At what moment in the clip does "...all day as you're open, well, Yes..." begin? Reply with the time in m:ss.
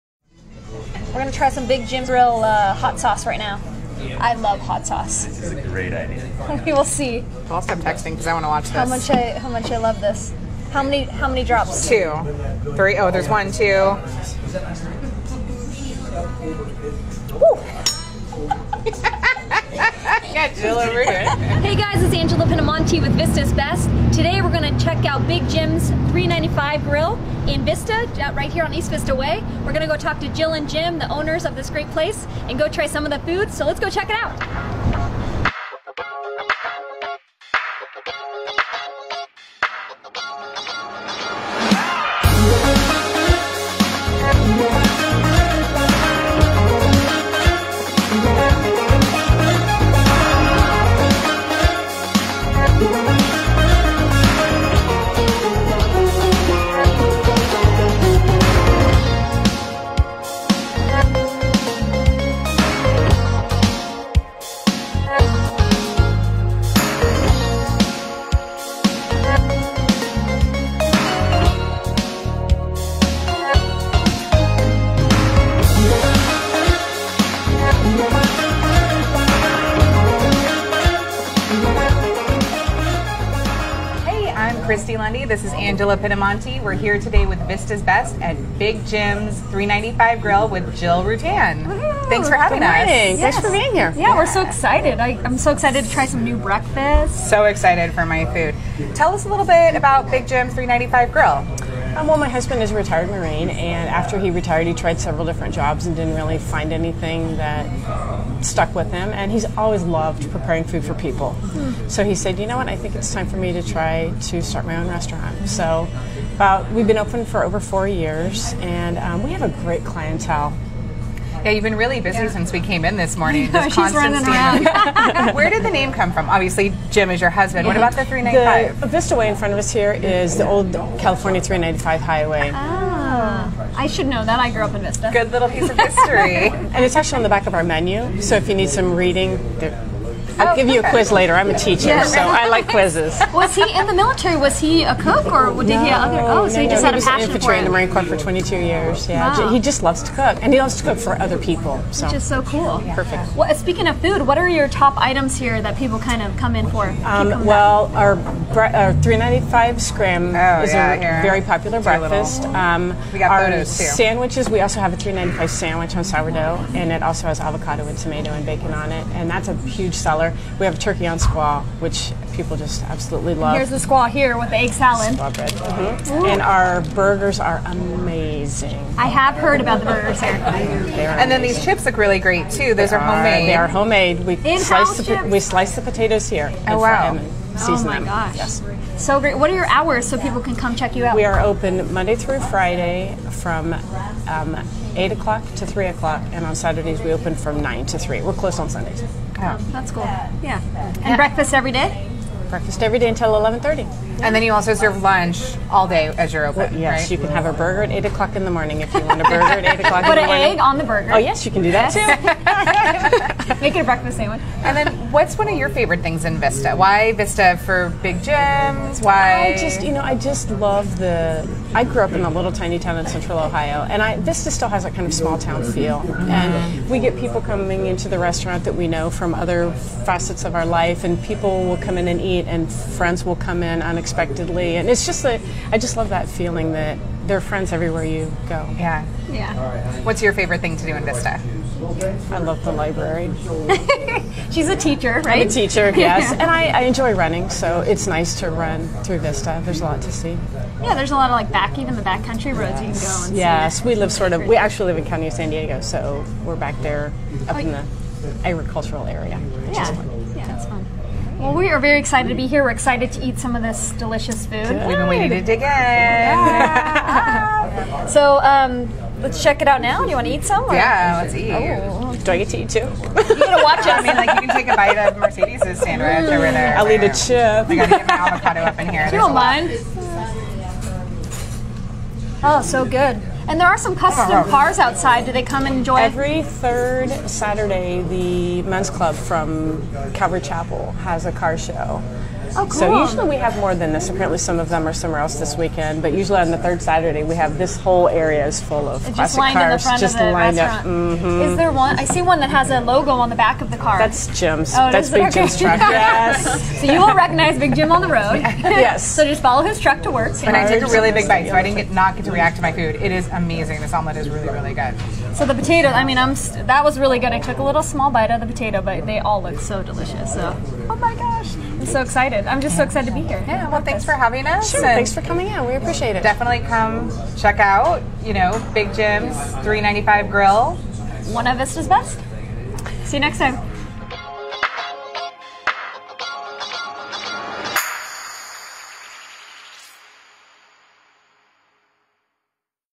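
3:25.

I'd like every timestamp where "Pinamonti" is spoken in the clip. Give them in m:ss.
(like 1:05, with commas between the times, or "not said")
0:22, 1:25.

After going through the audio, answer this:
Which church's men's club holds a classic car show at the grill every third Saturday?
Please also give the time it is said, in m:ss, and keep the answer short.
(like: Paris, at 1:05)
Calvary Chapel, at 4:50.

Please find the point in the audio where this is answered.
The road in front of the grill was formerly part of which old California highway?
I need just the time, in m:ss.
2:10.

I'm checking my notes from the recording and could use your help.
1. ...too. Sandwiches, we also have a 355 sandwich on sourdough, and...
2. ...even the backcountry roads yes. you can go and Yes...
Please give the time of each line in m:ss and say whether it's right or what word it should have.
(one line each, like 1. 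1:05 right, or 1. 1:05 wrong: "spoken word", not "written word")
1. 2:43 wrong: "395", not "355"
2. 4:11 right.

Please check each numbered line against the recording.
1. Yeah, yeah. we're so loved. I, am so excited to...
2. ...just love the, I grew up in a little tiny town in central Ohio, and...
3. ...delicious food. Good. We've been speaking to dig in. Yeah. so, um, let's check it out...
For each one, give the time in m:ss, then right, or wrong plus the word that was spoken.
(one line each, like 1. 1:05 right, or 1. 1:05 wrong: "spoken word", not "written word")
1. 1:33 wrong: "excited", not "loved"
2. 3:40 right
3. 4:23 wrong: "waiting", not "speaking".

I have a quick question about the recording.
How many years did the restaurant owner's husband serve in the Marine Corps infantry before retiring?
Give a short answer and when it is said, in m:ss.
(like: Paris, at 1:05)
22, at 2:28.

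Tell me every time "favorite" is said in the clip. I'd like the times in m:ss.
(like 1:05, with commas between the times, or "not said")
3:35, 4:00.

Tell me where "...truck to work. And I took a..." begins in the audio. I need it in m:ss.
5:09.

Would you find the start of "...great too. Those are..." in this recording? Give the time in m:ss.
3:02.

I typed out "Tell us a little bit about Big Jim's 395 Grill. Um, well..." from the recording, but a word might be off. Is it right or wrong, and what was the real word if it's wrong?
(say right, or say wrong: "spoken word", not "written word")
right.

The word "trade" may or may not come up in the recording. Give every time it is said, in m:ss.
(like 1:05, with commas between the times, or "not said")
not said.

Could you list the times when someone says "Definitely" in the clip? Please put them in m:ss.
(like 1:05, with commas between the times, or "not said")
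5:26.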